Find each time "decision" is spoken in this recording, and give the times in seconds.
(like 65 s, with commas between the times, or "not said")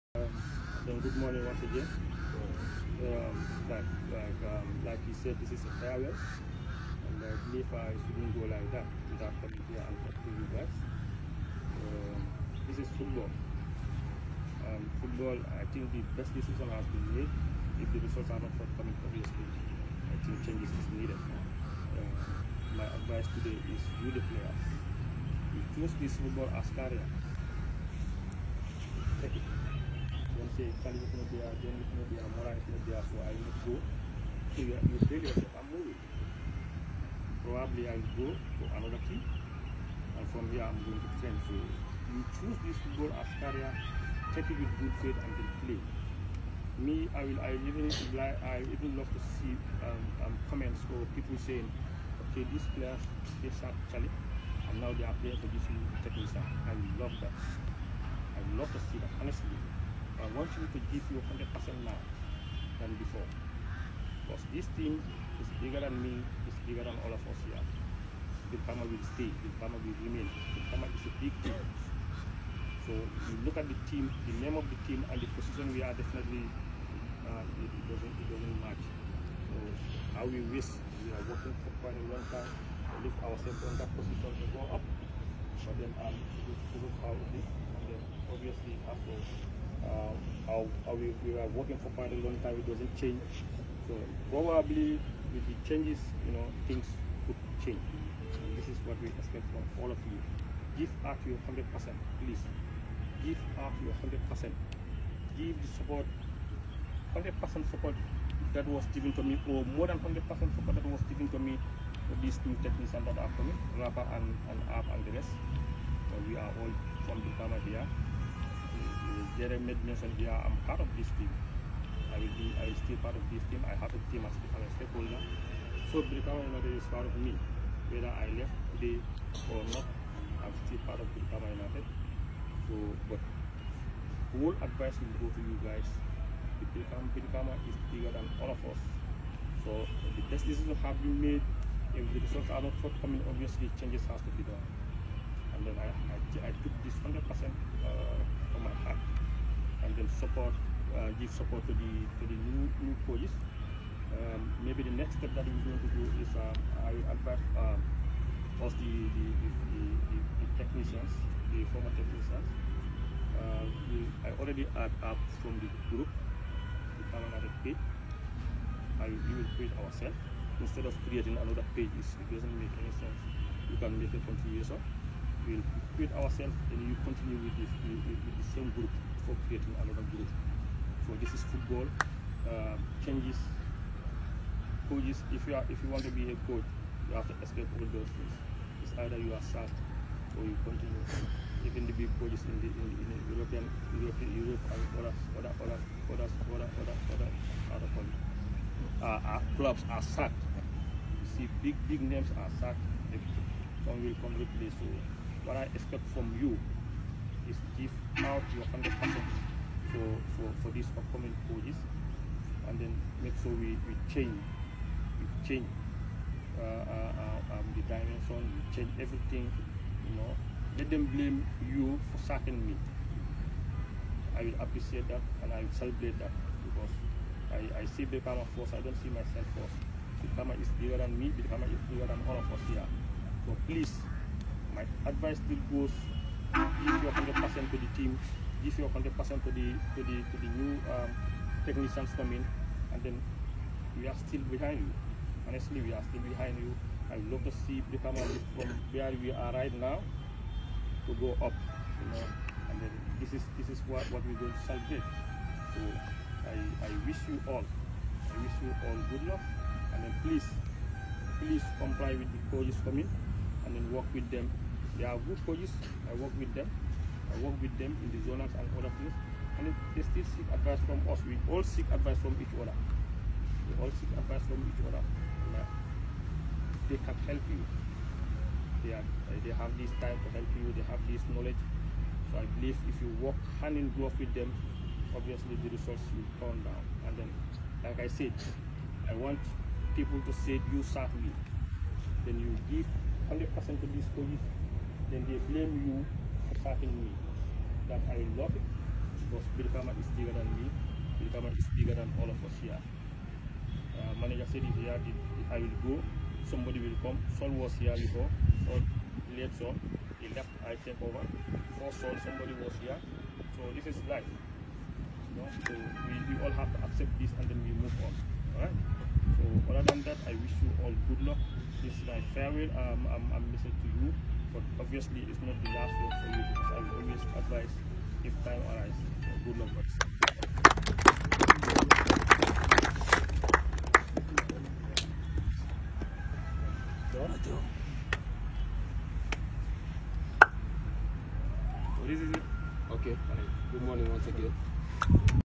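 16 s, 140 s.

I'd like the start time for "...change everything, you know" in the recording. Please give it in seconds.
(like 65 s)
218 s.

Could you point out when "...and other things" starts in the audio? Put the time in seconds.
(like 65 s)
268 s.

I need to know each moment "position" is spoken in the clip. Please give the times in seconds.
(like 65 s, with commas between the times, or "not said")
75 s, 83 s.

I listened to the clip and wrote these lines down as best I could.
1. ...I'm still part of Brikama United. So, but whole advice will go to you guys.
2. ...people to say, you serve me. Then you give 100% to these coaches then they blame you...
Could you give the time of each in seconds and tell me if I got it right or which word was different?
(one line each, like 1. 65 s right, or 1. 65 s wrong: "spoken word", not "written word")
1. 130 s right
2. 289 s right.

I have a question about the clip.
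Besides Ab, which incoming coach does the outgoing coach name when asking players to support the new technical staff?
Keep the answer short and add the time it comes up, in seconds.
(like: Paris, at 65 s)
Rafa, at 113 s.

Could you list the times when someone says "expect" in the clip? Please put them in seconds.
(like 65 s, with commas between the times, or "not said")
99 s, 205 s.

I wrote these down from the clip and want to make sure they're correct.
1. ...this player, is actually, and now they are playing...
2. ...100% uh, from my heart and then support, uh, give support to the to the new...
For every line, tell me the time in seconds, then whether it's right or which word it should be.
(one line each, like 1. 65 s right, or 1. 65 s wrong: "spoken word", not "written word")
1. 52 s right
2. 147 s right.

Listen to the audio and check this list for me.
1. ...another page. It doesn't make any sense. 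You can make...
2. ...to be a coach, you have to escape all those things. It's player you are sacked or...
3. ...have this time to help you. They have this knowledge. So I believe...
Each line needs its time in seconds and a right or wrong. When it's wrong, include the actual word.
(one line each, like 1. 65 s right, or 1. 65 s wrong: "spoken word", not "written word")
1. 171 s right
2. 186 s wrong: "either", not "player"
3. 279 s right.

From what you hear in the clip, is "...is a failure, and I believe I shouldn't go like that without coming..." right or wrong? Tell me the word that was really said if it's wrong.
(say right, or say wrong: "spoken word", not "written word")
right.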